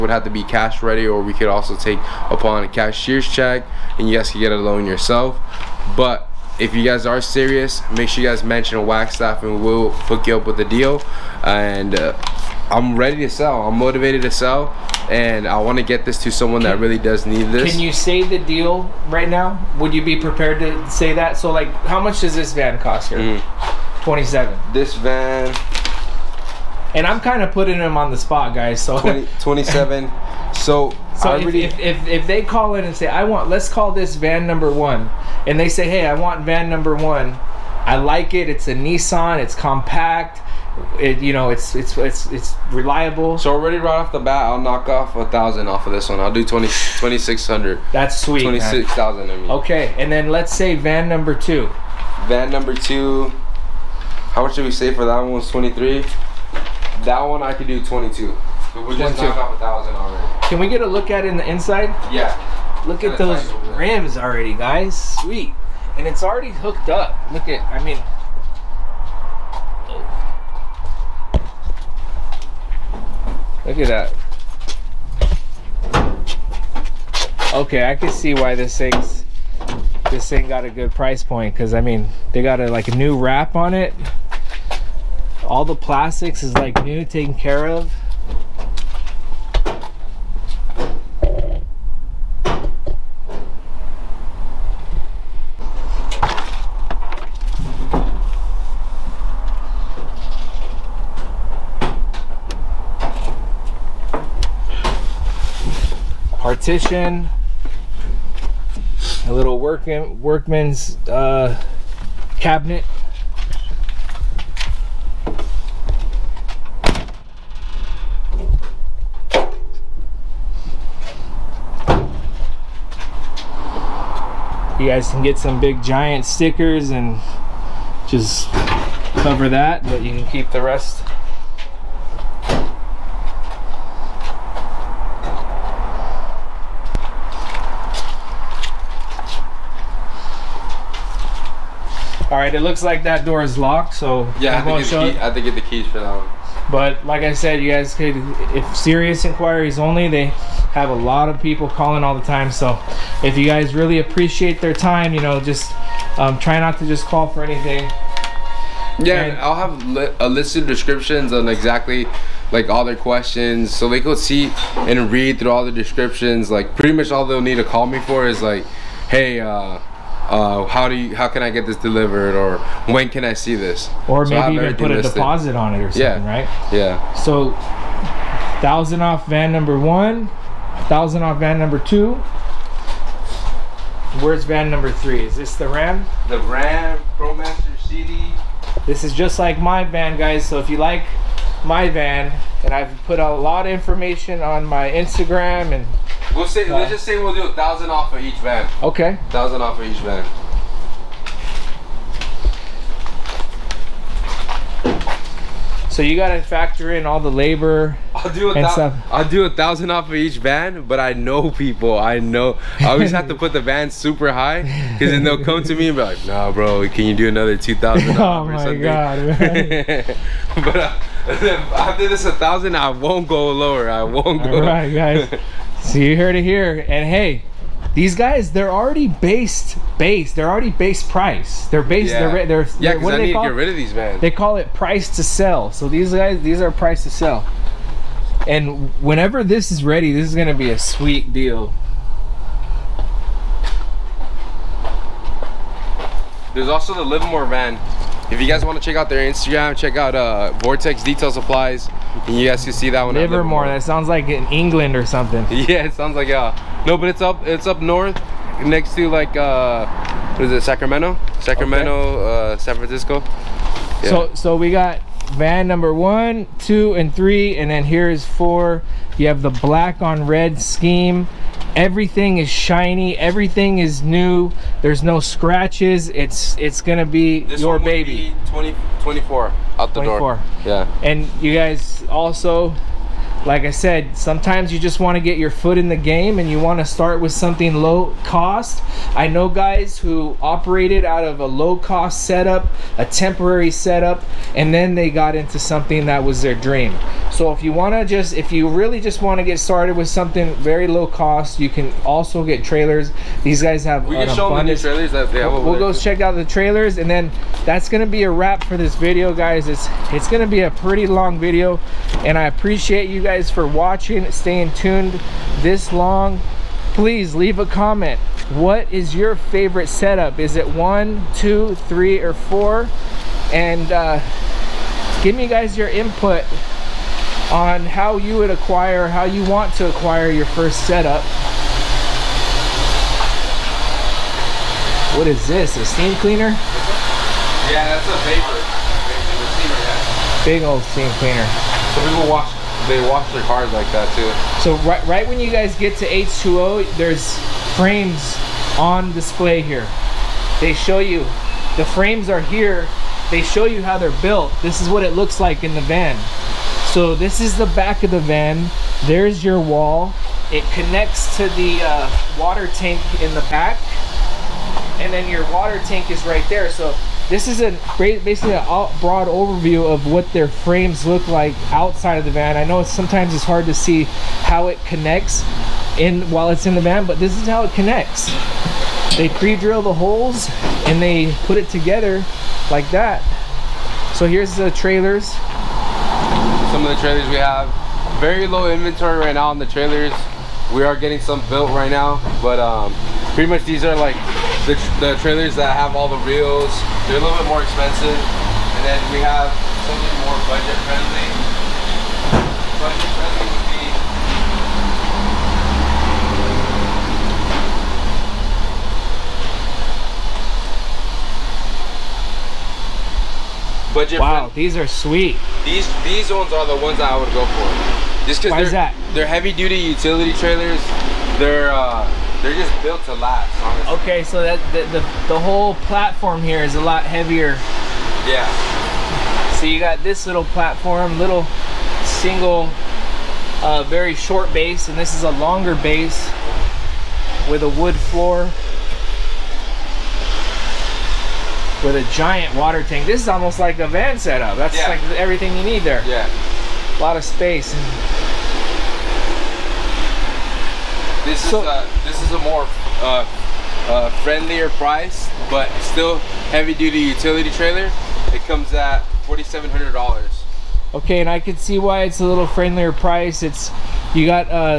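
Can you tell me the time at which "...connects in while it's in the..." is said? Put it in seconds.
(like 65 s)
374 s.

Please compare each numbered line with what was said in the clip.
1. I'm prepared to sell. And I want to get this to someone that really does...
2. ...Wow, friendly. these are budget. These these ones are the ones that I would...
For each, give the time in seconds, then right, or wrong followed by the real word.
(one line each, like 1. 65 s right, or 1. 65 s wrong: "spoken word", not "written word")
1. 13 s wrong: "motivated", not "prepared"
2. 414 s wrong: "sweet", not "budget".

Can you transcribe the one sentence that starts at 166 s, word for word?
Like pretty much all they'll need to call me for is like, hey.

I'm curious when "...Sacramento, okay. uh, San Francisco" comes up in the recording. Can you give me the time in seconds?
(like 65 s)
261 s.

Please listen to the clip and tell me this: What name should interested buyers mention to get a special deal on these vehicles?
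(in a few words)
Wagstaff.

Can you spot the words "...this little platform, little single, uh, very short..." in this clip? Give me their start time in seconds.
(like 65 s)
430 s.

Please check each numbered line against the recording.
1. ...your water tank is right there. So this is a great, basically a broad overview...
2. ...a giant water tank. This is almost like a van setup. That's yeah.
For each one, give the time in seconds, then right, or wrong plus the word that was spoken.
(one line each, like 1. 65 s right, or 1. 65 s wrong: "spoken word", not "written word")
1. 365 s right
2. 441 s right.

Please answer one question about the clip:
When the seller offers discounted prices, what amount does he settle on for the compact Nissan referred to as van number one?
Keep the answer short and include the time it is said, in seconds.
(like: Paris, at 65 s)
$26,000, at 48 s.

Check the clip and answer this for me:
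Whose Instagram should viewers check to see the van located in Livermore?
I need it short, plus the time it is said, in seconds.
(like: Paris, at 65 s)
Vortex Detail Supplies, at 250 s.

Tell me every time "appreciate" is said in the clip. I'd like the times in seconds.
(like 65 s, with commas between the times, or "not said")
153 s, 312 s.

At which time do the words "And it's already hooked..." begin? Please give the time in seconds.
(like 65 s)
65 s.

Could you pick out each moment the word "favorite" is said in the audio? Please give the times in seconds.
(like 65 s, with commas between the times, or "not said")
319 s.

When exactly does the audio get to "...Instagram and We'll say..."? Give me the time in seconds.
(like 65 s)
194 s.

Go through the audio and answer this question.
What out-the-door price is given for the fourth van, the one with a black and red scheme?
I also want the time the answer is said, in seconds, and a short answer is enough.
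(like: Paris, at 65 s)
$24,000, at 279 s.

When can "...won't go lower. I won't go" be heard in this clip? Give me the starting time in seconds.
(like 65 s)
222 s.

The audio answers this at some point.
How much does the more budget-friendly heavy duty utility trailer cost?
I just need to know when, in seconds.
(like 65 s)
459 s.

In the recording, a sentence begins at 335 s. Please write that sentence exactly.
What is this, a steam cleaner?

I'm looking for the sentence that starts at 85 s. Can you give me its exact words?
All the plastics is like new, taken care of.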